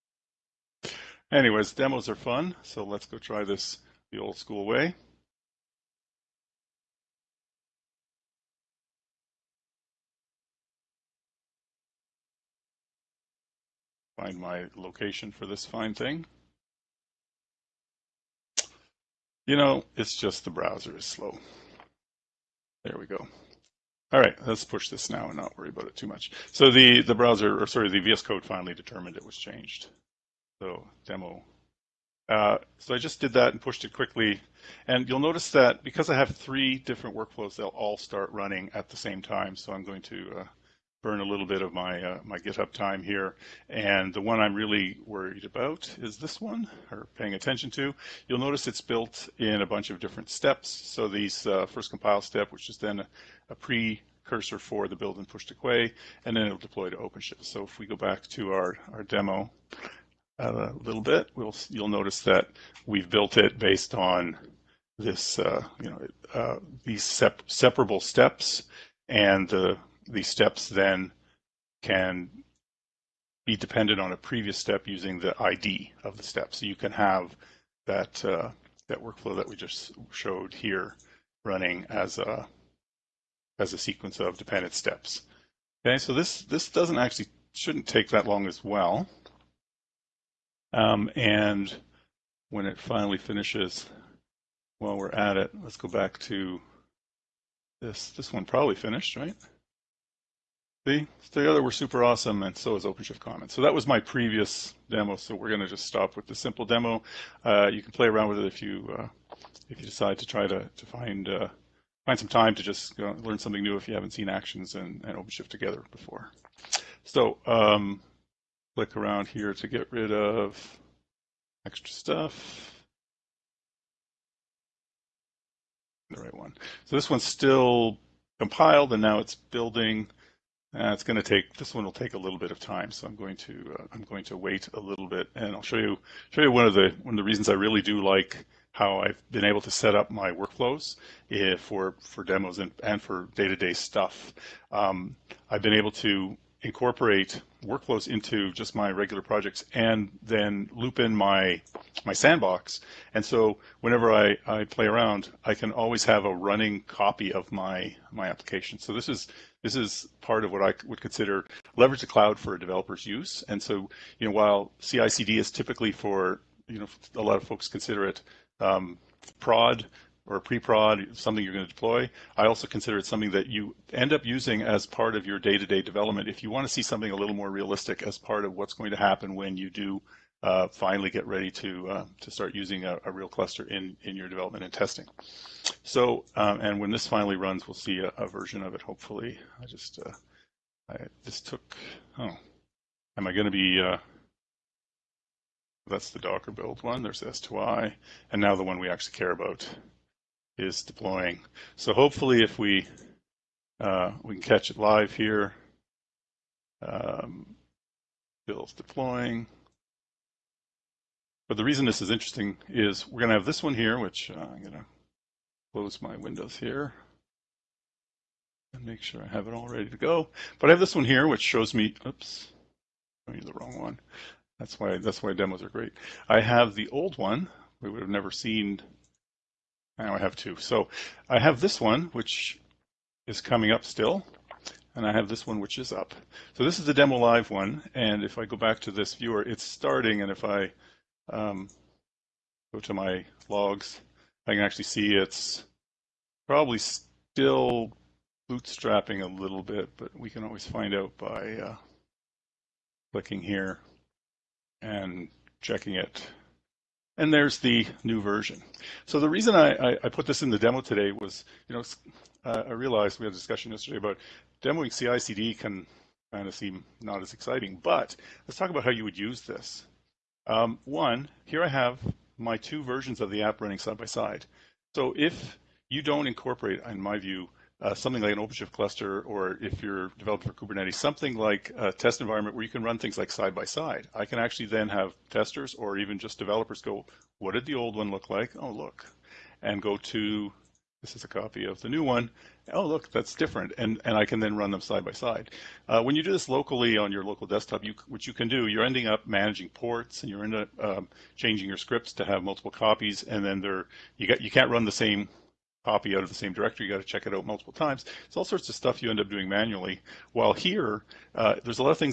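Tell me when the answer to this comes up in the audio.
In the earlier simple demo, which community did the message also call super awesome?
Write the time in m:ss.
1:42.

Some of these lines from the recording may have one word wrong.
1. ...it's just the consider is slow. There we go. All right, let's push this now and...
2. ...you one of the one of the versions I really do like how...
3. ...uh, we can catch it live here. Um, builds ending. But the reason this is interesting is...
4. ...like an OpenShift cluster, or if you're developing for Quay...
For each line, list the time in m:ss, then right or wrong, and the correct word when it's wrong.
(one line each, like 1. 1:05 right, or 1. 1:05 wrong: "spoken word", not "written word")
1. 0:19 wrong: "browser", not "consider"
2. 2:16 wrong: "reasons", not "versions"
3. 3:23 wrong: "deploying", not "ending"
4. 4:38 wrong: "Kubernetes", not "Quay".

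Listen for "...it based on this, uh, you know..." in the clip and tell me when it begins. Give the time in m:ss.
1:03.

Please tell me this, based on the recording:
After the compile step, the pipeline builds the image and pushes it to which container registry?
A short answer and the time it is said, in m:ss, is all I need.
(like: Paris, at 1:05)
Quay, at 0:55.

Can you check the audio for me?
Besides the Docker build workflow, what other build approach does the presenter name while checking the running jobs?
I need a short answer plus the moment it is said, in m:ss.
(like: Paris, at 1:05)
S2I, at 3:17.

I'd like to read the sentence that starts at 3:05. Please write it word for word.
So, um, and when this finally runs, we'll see a, a version of it.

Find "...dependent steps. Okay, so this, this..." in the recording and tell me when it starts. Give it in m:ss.
1:24.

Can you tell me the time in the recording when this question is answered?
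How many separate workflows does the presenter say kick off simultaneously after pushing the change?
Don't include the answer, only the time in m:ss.
0:36.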